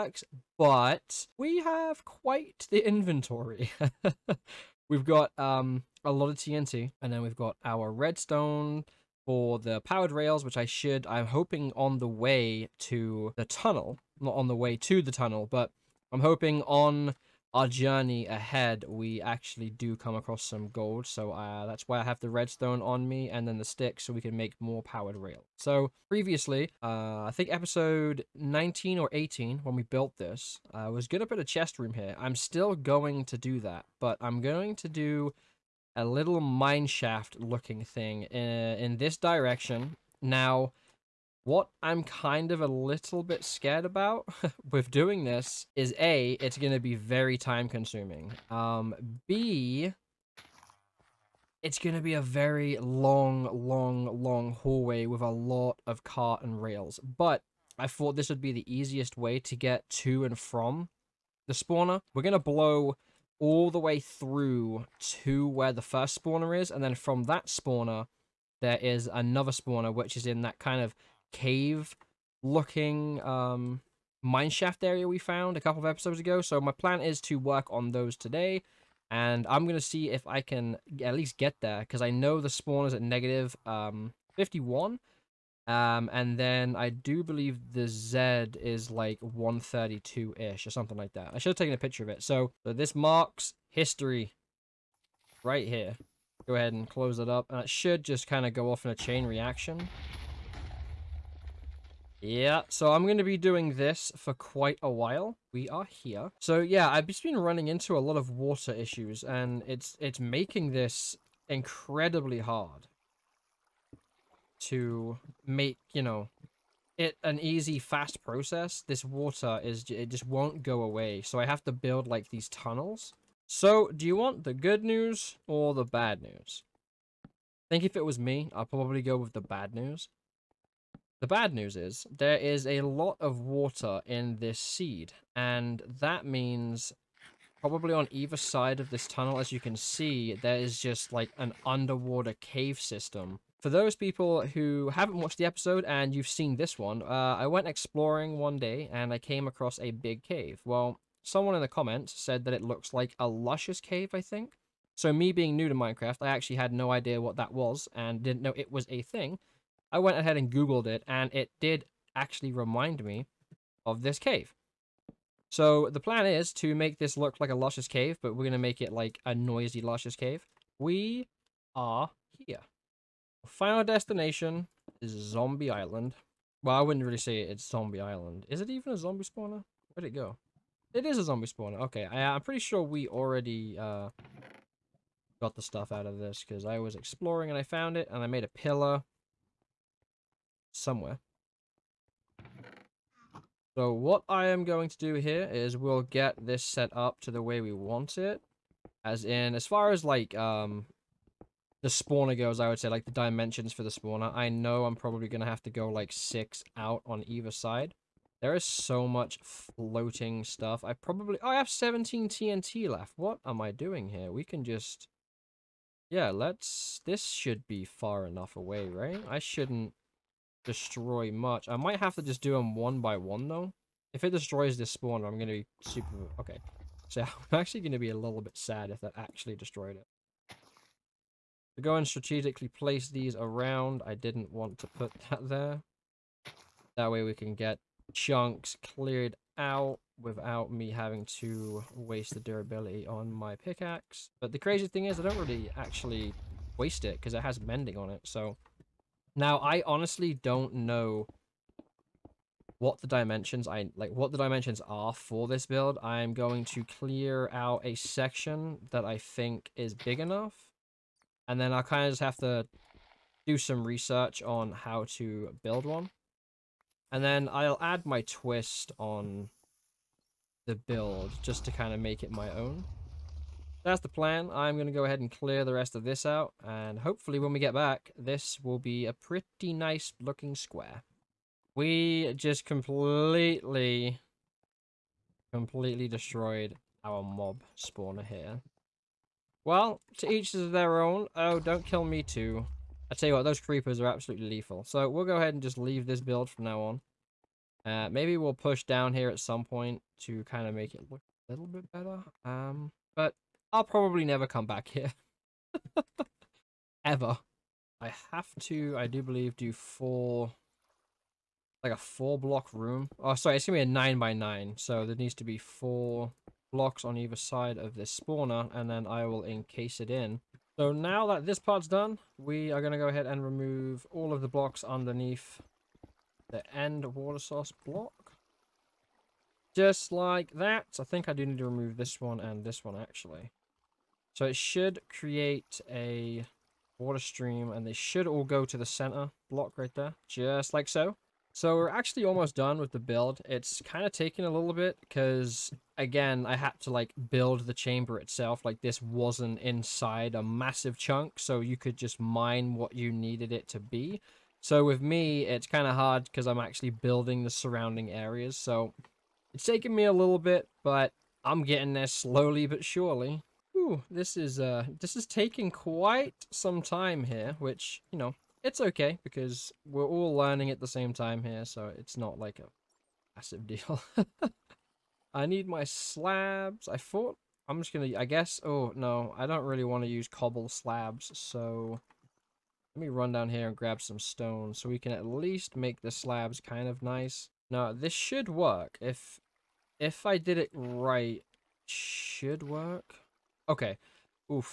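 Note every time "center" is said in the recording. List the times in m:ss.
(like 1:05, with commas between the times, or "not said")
5:38.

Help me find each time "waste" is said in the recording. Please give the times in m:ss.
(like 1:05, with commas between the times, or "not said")
4:01, 4:06.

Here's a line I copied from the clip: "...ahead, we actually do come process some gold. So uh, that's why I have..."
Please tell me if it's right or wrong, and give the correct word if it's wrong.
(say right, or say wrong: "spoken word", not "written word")
wrong: "across", not "process".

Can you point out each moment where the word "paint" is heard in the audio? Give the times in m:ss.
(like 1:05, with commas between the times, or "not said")
not said.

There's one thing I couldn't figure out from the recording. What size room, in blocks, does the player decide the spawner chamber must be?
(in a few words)
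9 by 9.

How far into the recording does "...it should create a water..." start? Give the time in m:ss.
5:34.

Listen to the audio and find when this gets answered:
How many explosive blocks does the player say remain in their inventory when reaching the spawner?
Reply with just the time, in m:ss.
3:31.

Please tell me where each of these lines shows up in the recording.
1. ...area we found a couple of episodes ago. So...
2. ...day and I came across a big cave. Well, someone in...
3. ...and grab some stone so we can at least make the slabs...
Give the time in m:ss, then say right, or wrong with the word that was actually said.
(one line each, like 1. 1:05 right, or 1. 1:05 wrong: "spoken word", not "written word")
1. 1:14 right
2. 2:28 right
3. 6:23 right.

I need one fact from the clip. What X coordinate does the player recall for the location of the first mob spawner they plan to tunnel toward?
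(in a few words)
-51.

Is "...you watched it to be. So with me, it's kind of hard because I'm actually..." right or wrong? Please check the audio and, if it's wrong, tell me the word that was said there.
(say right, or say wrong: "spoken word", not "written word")
wrong: "needed", not "watched".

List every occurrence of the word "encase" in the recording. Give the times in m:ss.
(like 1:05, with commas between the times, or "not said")
5:19.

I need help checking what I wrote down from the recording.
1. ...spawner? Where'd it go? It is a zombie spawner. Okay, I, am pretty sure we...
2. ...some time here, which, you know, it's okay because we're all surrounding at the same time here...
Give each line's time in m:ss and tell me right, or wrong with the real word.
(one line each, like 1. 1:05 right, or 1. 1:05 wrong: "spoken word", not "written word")
1. 2:59 right
2. 6:06 wrong: "learning", not "surrounding".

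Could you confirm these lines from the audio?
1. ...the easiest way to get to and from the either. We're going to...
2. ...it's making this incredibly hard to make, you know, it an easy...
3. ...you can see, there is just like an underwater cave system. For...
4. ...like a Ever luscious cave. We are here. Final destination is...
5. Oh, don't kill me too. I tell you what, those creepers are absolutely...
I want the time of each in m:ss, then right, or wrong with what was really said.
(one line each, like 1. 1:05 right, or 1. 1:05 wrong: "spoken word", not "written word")
1. 0:58 wrong: "spawner", not "either"
2. 1:50 right
3. 2:19 right
4. 2:48 wrong: "Noiizy", not "Ever"
5. 4:51 right.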